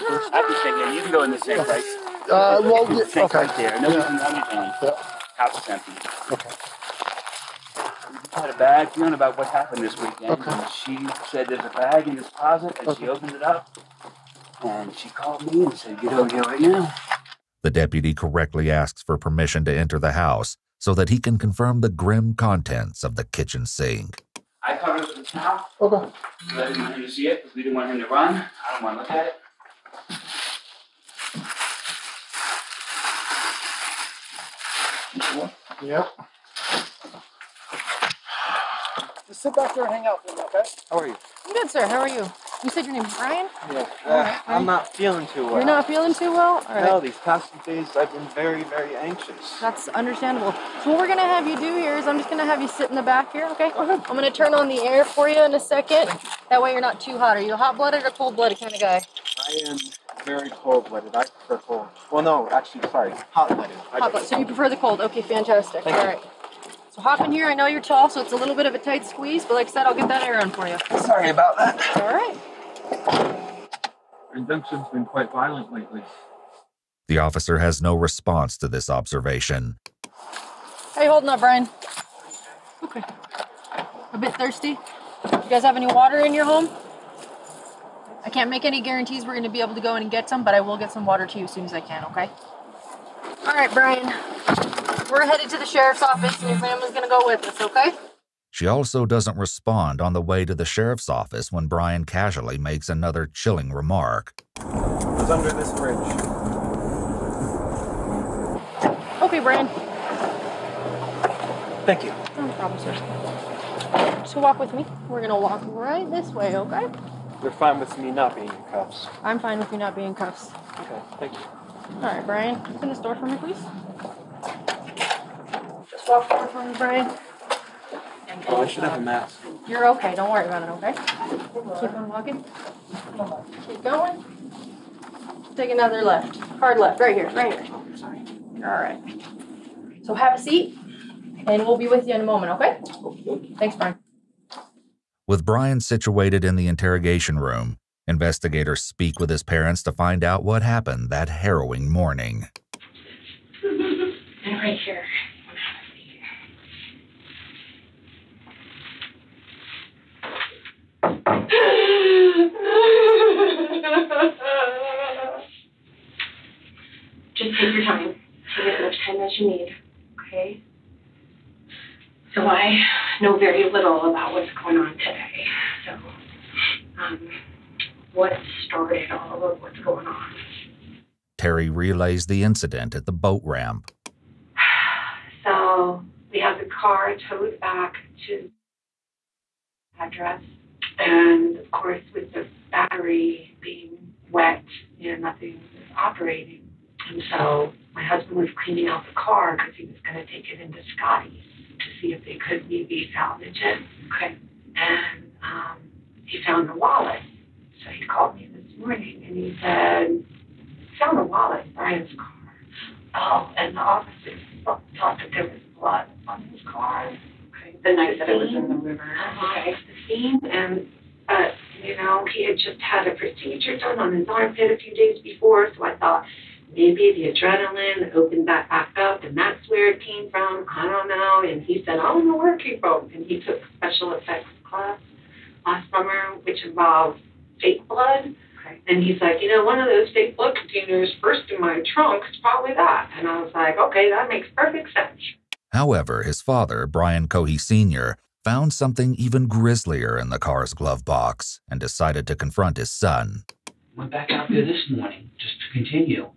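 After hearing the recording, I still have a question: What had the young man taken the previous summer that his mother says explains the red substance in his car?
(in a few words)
special effects class.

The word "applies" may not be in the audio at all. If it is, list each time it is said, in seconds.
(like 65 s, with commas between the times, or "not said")
not said.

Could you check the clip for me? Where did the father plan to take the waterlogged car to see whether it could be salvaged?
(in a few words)
Scotty's.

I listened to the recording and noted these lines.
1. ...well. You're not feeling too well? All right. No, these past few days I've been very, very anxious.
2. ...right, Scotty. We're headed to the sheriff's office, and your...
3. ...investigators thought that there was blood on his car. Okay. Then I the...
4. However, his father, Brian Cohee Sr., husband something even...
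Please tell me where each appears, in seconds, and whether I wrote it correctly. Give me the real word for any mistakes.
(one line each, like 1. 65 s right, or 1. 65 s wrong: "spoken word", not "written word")
1. 45 s right
2. 93 s wrong: "Brian", not "Scotty"
3. 213 s wrong: "officers", not "investigators"
4. 245 s wrong: "found", not "husband".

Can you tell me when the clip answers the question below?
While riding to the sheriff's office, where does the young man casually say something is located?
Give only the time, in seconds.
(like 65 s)
105 s.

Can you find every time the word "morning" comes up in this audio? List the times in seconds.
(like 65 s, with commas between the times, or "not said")
151 s, 208 s, 254 s.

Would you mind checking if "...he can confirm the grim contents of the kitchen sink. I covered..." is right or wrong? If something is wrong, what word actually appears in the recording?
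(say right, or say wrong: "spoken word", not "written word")
right.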